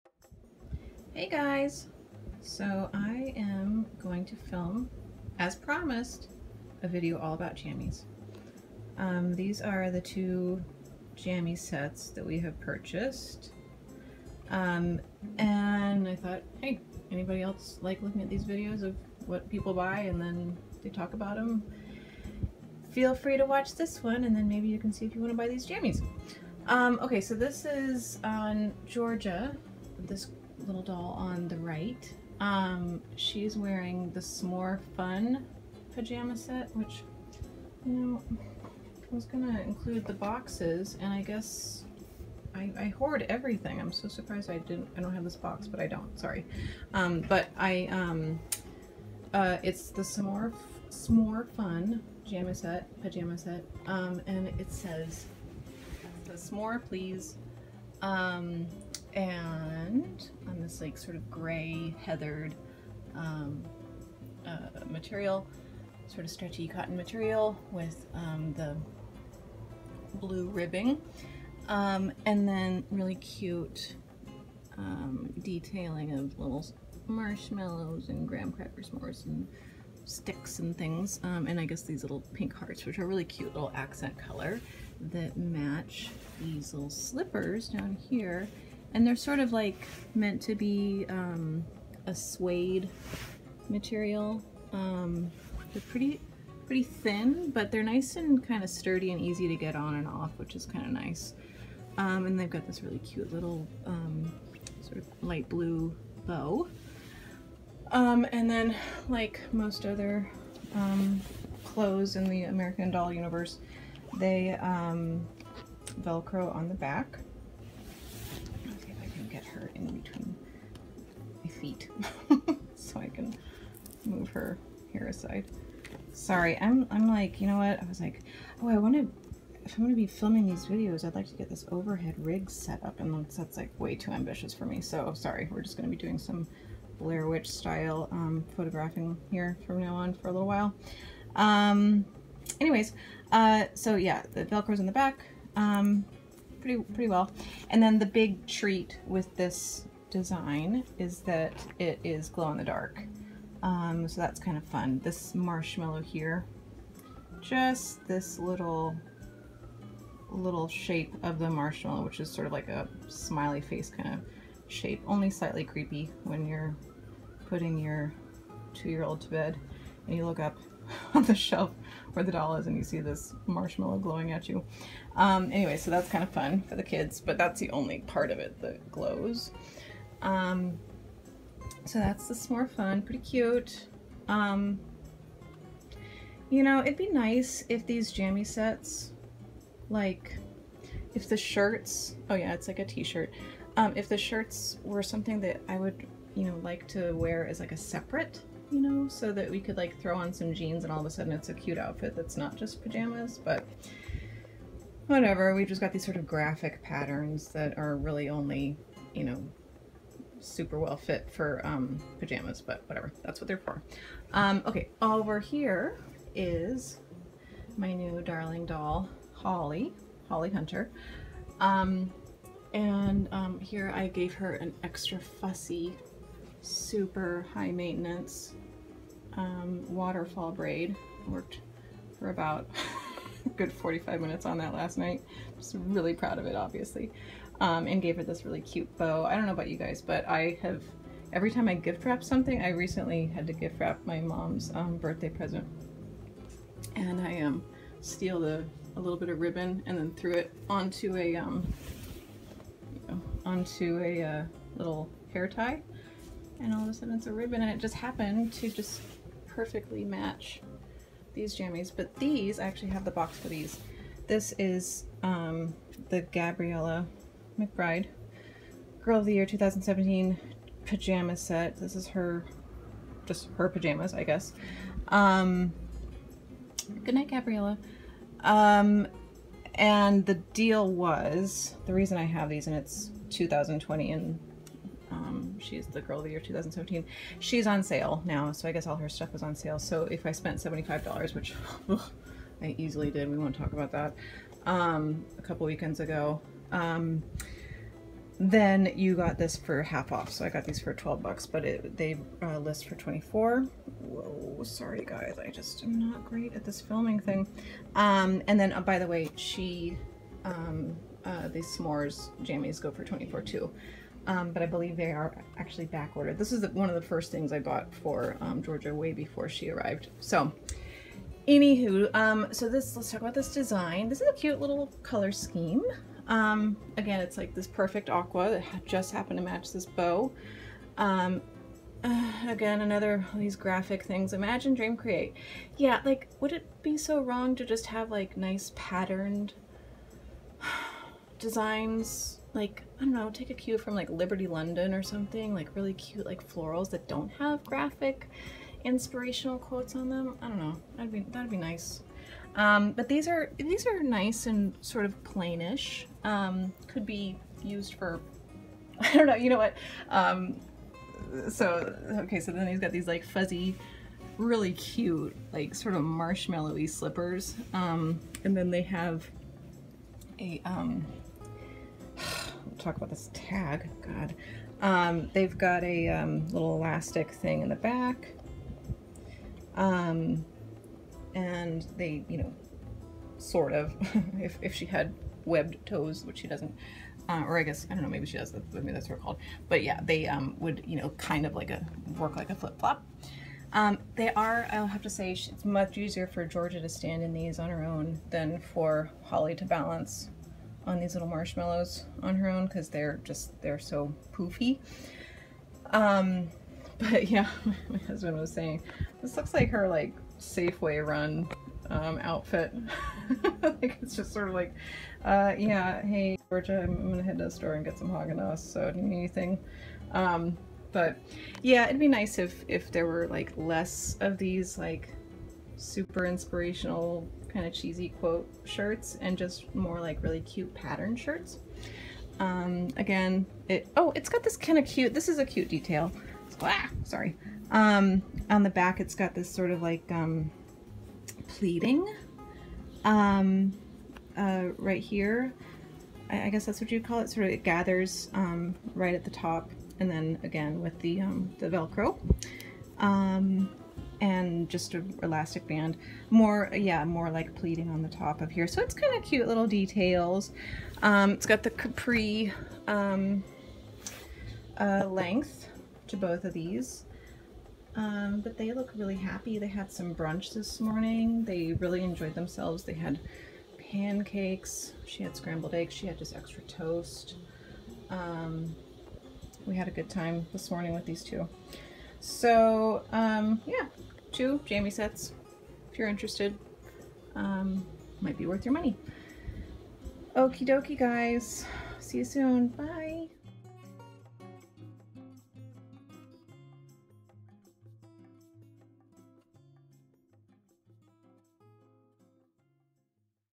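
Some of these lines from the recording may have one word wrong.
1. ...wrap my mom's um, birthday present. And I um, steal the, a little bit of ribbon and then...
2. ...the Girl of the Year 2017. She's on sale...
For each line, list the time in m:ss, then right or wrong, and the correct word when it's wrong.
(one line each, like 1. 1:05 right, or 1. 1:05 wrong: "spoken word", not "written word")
1. 4:03 right
2. 4:45 right.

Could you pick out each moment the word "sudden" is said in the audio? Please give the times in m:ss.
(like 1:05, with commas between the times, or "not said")
3:21, 4:16.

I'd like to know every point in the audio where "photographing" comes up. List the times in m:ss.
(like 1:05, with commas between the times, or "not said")
2:18.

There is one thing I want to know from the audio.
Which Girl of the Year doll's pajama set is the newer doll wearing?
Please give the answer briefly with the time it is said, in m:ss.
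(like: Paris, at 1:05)
Gabriela McBride, at 4:26.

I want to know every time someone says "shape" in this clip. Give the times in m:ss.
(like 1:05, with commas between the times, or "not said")
2:40, 2:44.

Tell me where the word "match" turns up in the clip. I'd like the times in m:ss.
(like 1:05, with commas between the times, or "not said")
1:25, 4:20, 5:29.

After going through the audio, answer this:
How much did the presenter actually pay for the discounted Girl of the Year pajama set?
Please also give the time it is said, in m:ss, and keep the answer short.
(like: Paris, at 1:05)
$12, at 5:00.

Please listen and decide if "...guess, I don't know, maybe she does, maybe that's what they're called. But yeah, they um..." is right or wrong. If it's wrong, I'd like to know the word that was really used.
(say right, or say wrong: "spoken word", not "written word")
right.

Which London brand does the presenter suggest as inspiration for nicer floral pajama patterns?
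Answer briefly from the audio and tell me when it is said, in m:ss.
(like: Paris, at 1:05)
Liberty London, at 5:44.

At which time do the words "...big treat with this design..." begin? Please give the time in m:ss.
2:28.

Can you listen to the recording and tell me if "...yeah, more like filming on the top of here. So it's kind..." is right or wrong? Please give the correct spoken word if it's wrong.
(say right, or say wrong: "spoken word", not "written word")
wrong: "pleating", not "filming".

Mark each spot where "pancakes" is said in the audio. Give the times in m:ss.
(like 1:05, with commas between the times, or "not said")
7:53.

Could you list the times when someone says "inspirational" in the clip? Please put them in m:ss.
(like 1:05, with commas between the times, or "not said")
5:48, 7:06.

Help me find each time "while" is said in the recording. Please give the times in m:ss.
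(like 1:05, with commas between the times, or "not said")
2:20.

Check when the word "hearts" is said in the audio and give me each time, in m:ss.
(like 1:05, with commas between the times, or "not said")
1:22.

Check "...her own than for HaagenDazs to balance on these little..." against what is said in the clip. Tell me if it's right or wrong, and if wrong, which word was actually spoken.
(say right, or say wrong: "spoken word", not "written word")
wrong: "Holly", not "HaagenDazs".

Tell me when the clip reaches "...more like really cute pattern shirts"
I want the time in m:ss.
7:09.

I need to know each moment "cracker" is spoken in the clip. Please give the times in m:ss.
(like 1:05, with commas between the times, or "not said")
1:18.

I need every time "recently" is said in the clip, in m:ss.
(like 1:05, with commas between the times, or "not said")
4:02.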